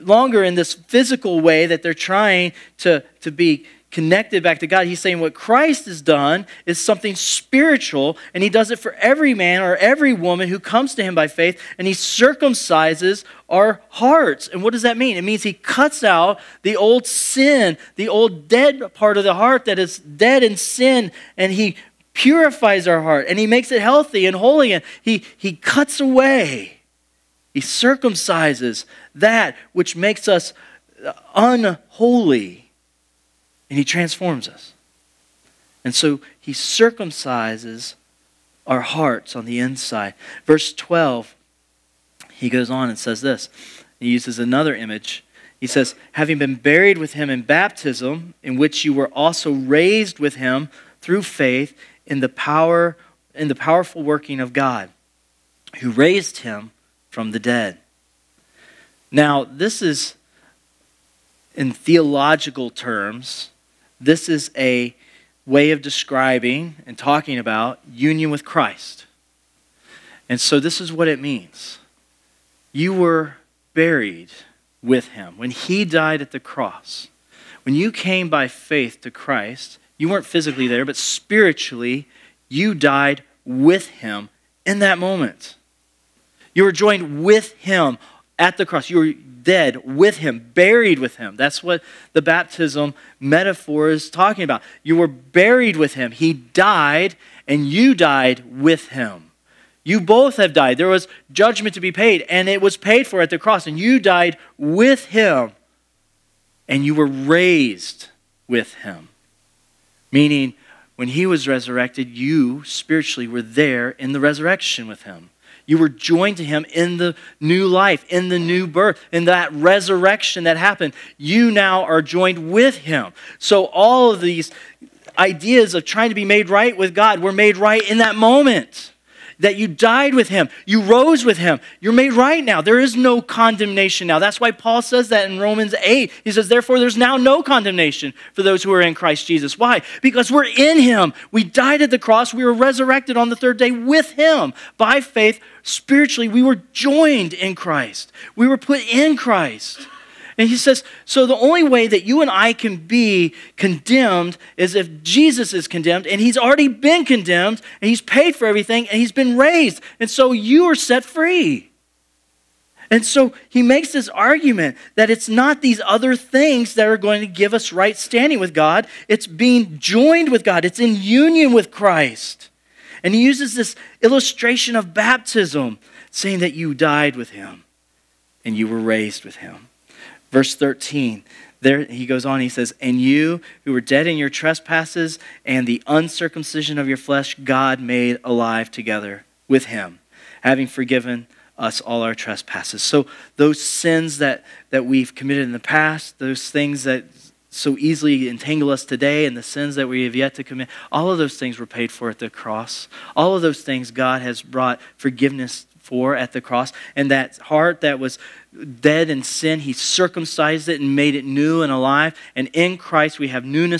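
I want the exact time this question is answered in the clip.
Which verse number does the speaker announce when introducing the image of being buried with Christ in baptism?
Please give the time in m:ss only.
0:40.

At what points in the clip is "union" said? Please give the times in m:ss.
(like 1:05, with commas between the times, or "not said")
1:07, 2:51.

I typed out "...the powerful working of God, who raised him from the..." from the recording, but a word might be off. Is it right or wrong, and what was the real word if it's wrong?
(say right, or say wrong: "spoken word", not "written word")
right.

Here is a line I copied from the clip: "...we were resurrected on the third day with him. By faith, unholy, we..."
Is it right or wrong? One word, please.
wrong.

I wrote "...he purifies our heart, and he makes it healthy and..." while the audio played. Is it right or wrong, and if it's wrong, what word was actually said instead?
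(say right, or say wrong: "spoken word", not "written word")
right.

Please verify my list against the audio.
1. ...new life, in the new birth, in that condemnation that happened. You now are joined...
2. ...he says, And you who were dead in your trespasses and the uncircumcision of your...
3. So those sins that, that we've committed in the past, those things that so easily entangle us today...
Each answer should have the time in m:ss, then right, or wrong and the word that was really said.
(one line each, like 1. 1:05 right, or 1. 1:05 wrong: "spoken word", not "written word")
1. 1:57 wrong: "resurrection", not "condemnation"
2. 3:02 right
3. 3:12 right.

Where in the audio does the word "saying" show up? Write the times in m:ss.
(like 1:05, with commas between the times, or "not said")
0:04, 2:56.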